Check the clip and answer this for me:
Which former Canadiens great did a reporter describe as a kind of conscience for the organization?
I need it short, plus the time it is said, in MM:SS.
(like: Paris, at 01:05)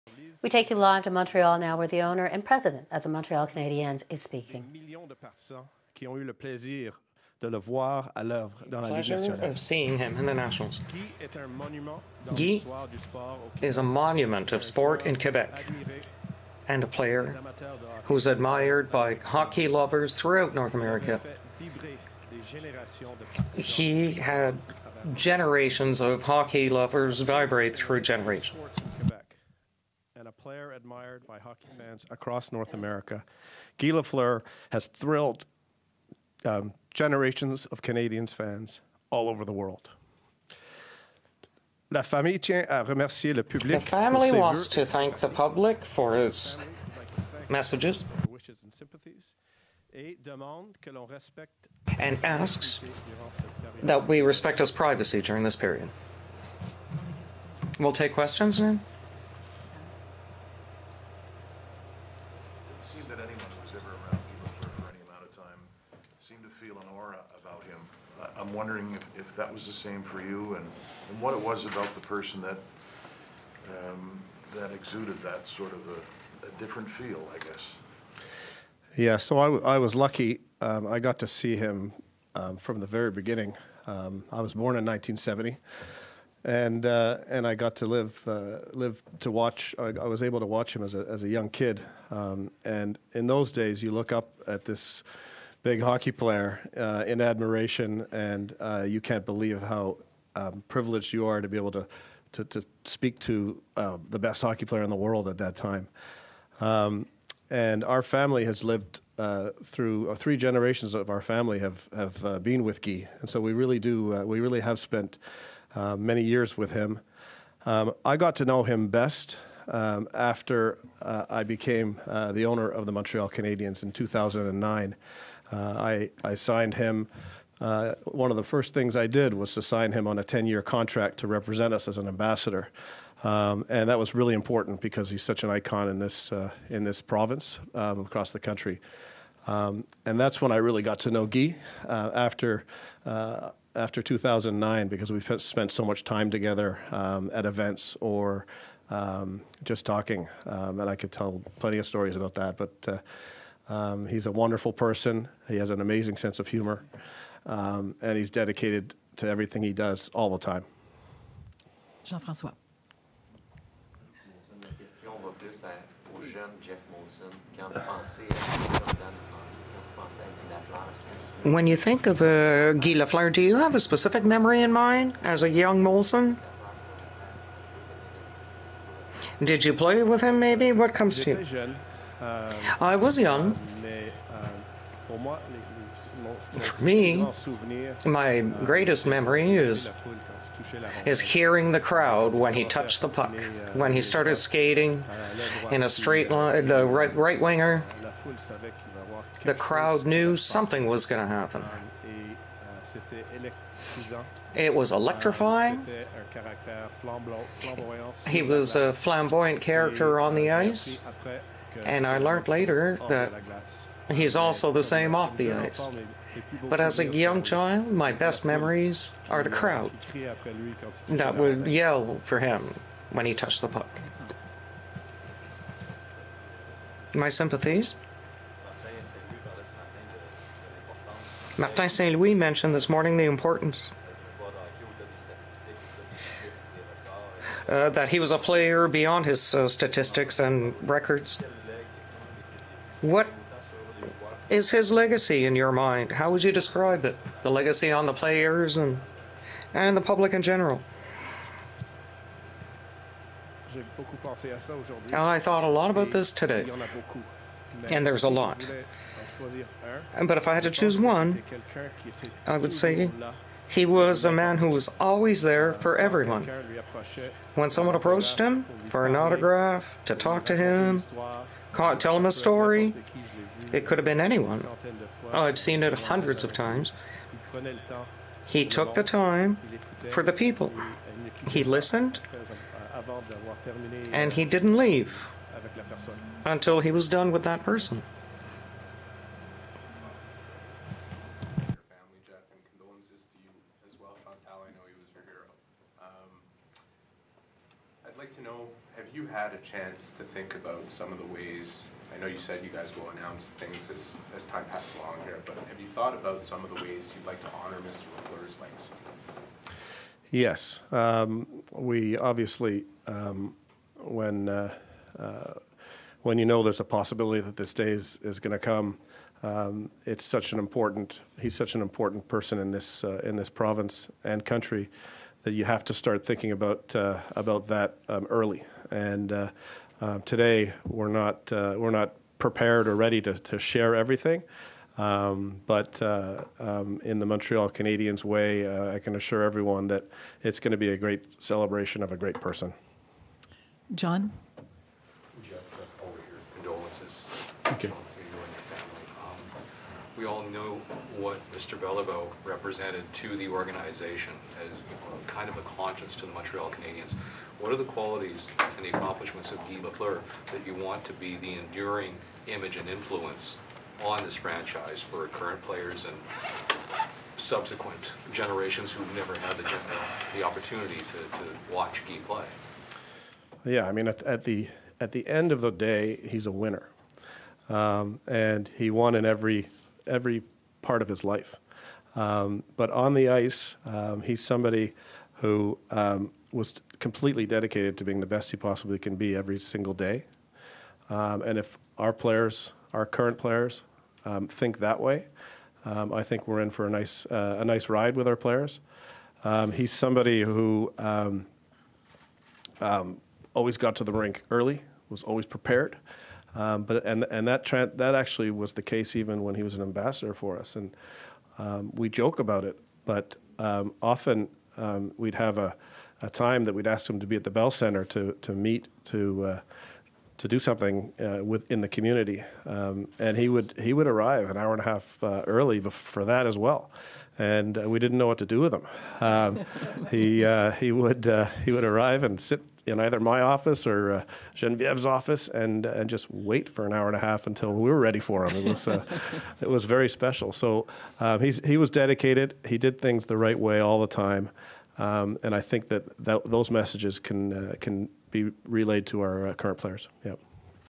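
Beliveau, at 05:51.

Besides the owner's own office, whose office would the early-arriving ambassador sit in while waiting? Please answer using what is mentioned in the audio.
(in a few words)
Genevieve.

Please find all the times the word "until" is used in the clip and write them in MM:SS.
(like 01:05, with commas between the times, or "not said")
04:46, 07:17.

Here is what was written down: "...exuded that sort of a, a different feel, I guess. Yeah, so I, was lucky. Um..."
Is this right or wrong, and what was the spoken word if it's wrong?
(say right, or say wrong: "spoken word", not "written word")
right.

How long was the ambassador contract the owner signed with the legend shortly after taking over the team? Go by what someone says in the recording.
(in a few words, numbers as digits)
10 year.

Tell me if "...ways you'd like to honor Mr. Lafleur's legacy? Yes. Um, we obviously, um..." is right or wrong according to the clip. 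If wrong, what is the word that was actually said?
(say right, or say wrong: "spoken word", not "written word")
right.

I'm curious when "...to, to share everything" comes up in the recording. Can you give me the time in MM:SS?
05:33.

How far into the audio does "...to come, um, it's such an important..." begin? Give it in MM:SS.
05:18.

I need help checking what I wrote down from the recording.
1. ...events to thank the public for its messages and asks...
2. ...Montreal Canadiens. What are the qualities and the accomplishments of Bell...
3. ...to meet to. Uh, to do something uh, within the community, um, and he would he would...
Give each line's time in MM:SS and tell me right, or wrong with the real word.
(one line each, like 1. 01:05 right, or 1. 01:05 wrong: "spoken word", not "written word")
1. 00:44 wrong: "wants", not "events"
2. 05:56 wrong: "Guy", not "Bell"
3. 06:58 right.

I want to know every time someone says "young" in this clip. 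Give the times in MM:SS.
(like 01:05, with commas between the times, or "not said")
01:31, 02:55, 03:03, 03:37.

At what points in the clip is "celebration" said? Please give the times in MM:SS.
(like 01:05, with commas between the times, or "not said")
05:41.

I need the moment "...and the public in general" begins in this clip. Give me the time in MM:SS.
04:09.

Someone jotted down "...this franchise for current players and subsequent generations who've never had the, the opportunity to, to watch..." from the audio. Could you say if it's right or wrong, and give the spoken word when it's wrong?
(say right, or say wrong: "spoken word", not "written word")
right.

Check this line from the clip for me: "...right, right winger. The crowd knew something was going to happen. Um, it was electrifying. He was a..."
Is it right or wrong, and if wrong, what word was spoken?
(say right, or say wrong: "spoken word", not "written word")
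right.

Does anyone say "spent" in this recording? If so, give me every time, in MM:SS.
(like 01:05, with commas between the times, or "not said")
01:54, 02:25.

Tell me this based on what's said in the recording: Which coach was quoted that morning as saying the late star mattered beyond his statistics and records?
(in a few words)
Martin Saint Louis.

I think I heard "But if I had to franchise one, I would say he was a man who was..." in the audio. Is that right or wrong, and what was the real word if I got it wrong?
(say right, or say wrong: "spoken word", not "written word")
wrong: "choose", not "franchise".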